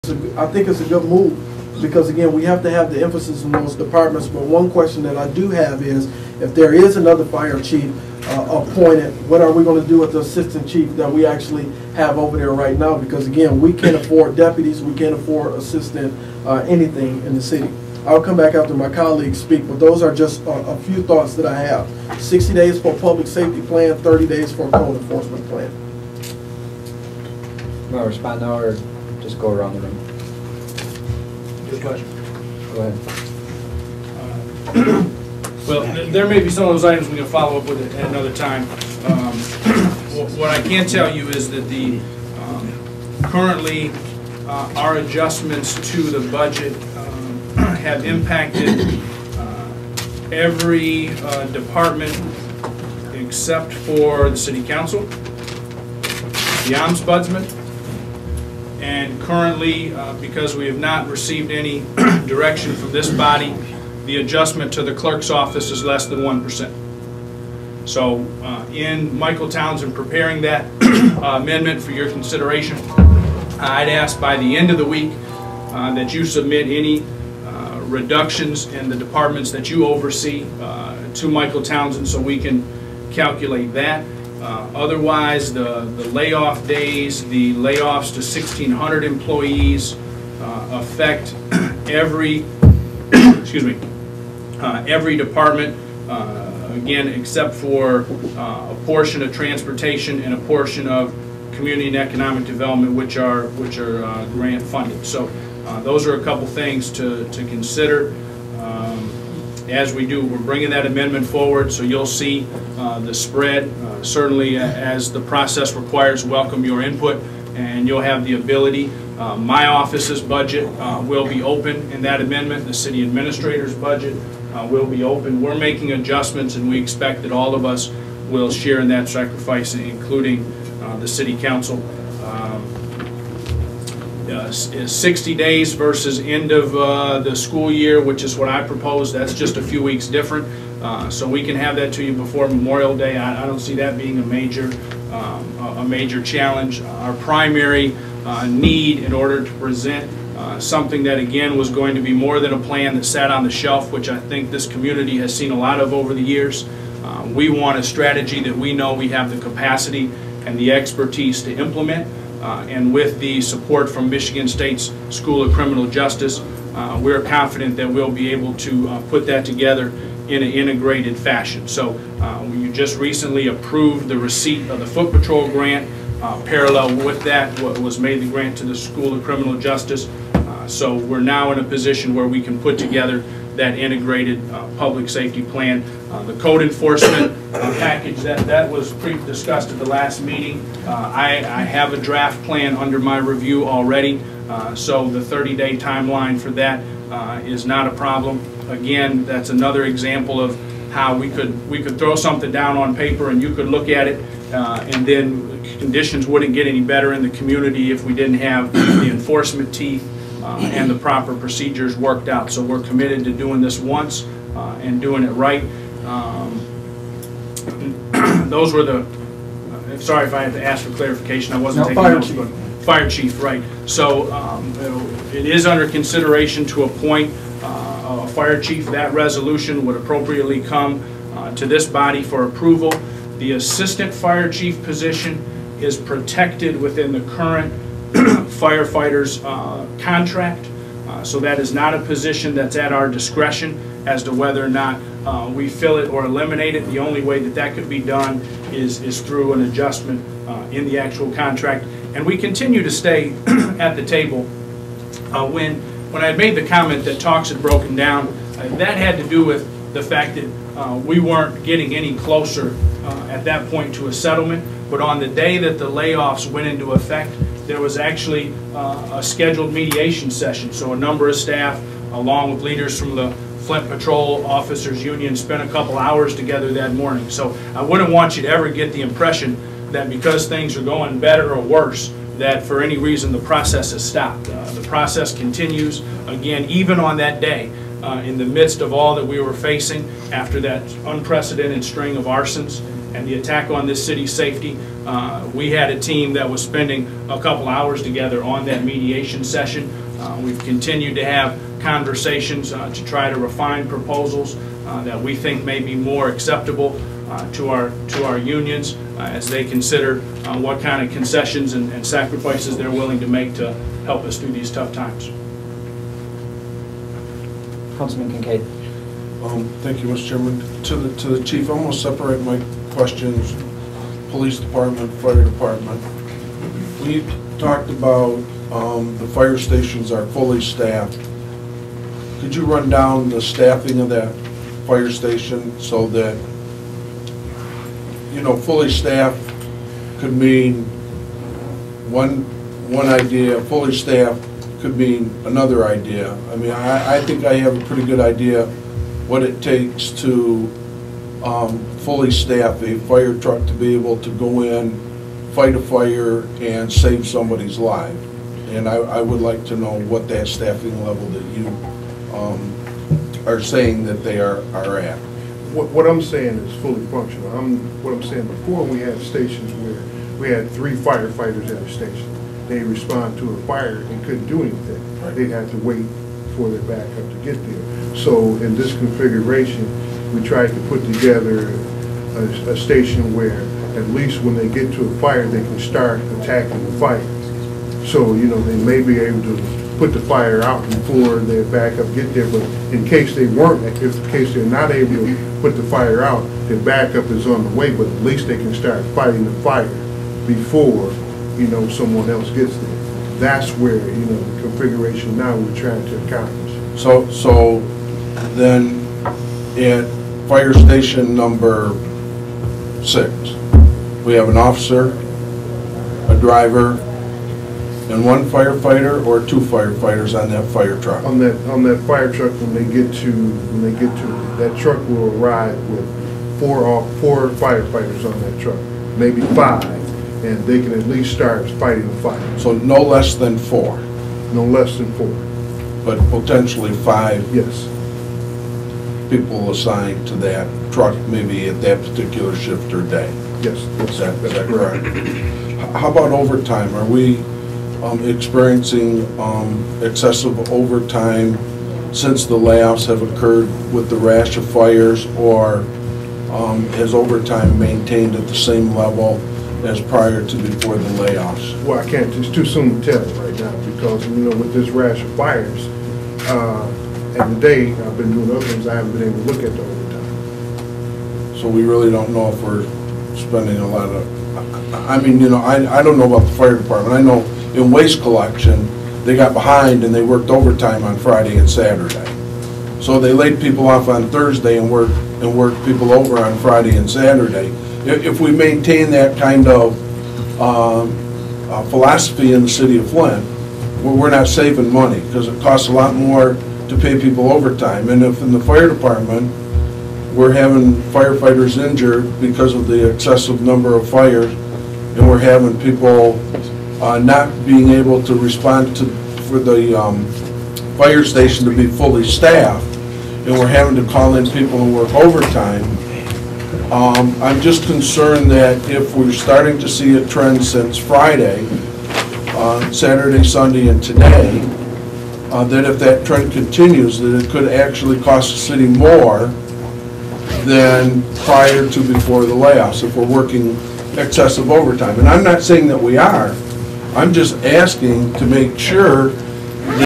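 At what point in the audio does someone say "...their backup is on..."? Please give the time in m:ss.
6:36.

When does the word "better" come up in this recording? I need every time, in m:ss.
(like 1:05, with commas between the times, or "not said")
3:26, 4:41.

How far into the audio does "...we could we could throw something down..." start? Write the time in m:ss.
3:21.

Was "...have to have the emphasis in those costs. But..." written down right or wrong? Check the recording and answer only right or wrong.
wrong.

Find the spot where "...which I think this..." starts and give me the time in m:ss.
2:33.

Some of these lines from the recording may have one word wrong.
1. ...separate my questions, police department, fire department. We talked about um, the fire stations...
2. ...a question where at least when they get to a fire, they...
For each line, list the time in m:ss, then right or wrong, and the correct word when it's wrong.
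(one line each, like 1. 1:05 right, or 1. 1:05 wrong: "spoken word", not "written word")
1. 5:21 right
2. 6:22 wrong: "station", not "question".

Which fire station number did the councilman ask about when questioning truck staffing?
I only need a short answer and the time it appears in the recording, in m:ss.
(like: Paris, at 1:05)
6, at 6:50.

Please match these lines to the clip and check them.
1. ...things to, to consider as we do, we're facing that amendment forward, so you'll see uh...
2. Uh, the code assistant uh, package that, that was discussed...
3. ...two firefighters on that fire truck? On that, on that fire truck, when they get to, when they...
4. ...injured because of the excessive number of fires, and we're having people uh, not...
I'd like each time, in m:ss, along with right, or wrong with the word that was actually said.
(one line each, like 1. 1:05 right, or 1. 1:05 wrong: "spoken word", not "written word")
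1. 1:46 wrong: "bringing", not "facing"
2. 3:06 wrong: "enforcement", not "assistant"
3. 6:59 right
4. 8:21 right.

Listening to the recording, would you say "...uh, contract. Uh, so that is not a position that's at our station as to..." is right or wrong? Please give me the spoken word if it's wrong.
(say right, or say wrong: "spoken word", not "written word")
wrong: "discretion", not "station".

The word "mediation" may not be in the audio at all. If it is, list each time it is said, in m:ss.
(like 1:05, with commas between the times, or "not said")
4:29, 4:58.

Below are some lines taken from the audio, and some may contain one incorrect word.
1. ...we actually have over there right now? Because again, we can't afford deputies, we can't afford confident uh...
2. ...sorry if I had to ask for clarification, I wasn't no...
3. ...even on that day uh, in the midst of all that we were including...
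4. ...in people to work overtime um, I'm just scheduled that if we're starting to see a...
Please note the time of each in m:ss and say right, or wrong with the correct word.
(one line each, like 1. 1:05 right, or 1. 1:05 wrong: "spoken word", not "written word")
1. 0:11 wrong: "assistant", not "confident"
2. 3:39 right
3. 4:46 wrong: "facing", not "including"
4. 8:34 wrong: "concerned", not "scheduled".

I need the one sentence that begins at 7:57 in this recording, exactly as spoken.
I know in waste collection, they got behind and they worked overtime on Friday and Saturday.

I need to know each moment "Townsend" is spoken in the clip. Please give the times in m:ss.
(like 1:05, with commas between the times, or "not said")
1:09, 1:21.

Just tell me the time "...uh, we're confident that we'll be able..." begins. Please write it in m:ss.
2:46.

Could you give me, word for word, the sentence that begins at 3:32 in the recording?
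So we're committed to doing this once uh, and doing it right.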